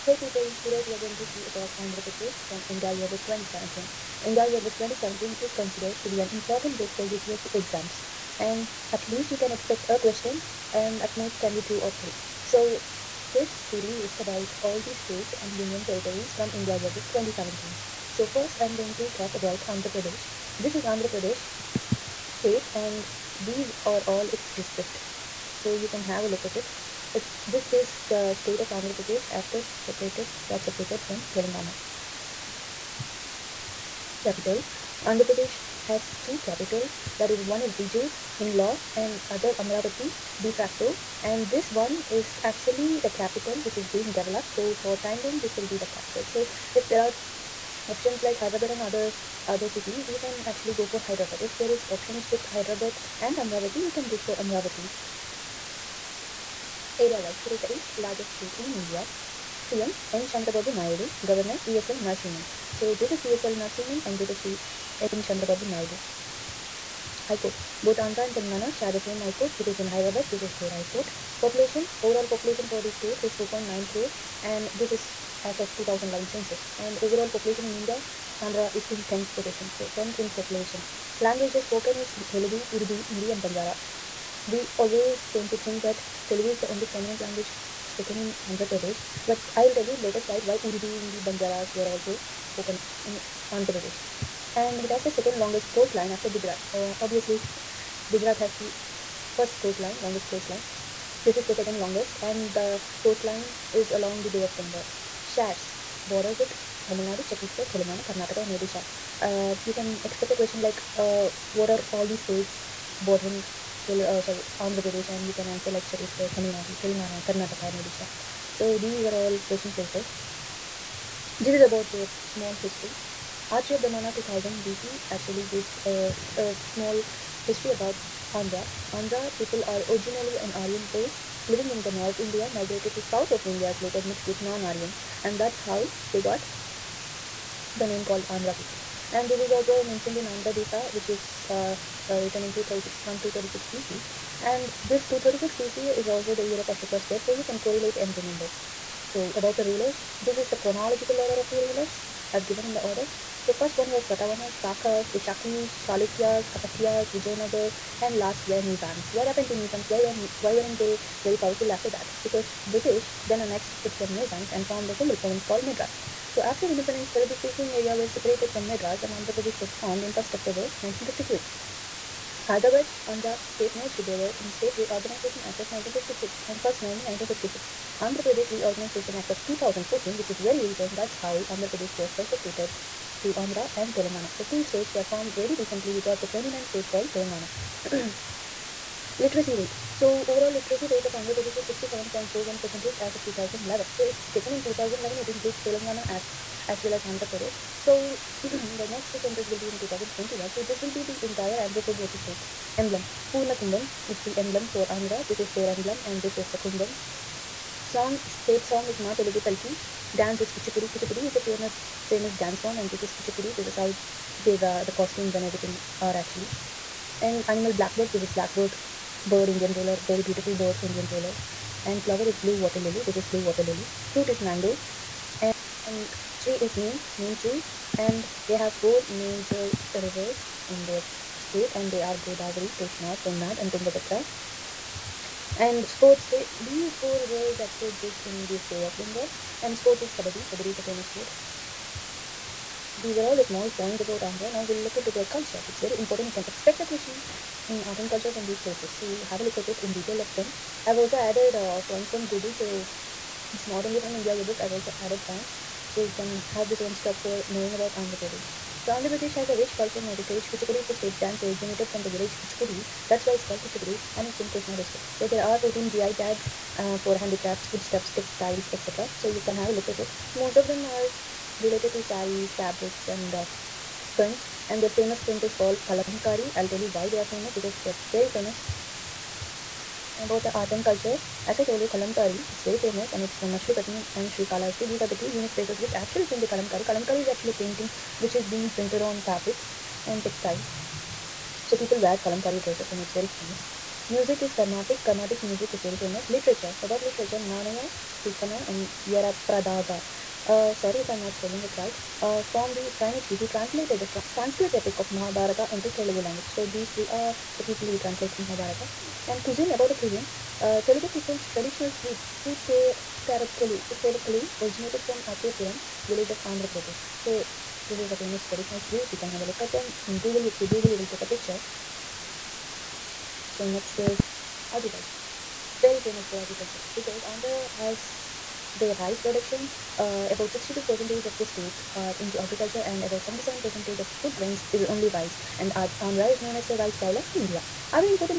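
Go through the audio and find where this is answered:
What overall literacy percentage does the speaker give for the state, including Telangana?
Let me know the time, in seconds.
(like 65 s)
191 s.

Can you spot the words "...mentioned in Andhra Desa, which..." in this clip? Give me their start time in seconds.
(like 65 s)
139 s.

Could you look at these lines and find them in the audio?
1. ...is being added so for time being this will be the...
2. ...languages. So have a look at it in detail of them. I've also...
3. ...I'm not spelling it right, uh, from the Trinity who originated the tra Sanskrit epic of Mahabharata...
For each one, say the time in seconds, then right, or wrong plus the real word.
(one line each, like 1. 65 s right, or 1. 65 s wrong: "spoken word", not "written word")
1. 43 s wrong: "developed", not "added"
2. 248 s wrong: "places", not "languages"
3. 301 s wrong: "translated", not "originated".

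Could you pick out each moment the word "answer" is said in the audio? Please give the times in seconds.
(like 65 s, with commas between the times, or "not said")
115 s, 201 s.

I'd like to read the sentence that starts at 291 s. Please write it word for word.
So people wear Kalamkari dresses and it's very famous.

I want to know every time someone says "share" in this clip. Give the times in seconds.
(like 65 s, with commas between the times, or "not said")
68 s, 105 s.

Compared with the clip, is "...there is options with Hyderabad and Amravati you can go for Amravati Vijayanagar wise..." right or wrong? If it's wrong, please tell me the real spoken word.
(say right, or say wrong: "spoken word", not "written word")
wrong: "Area", not "Vijayanagar".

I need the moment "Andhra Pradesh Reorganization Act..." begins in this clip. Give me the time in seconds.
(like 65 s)
178 s.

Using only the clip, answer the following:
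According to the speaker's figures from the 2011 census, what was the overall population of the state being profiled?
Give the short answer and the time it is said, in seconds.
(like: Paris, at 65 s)
4.9 crore, at 73 s.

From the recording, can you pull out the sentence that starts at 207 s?
Song, state song is Ma Telugu Talki.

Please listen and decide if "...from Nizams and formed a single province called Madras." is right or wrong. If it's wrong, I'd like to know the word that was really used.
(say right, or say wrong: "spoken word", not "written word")
right.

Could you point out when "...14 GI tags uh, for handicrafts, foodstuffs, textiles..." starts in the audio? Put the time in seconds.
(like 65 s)
265 s.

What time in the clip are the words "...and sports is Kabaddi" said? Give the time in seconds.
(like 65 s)
239 s.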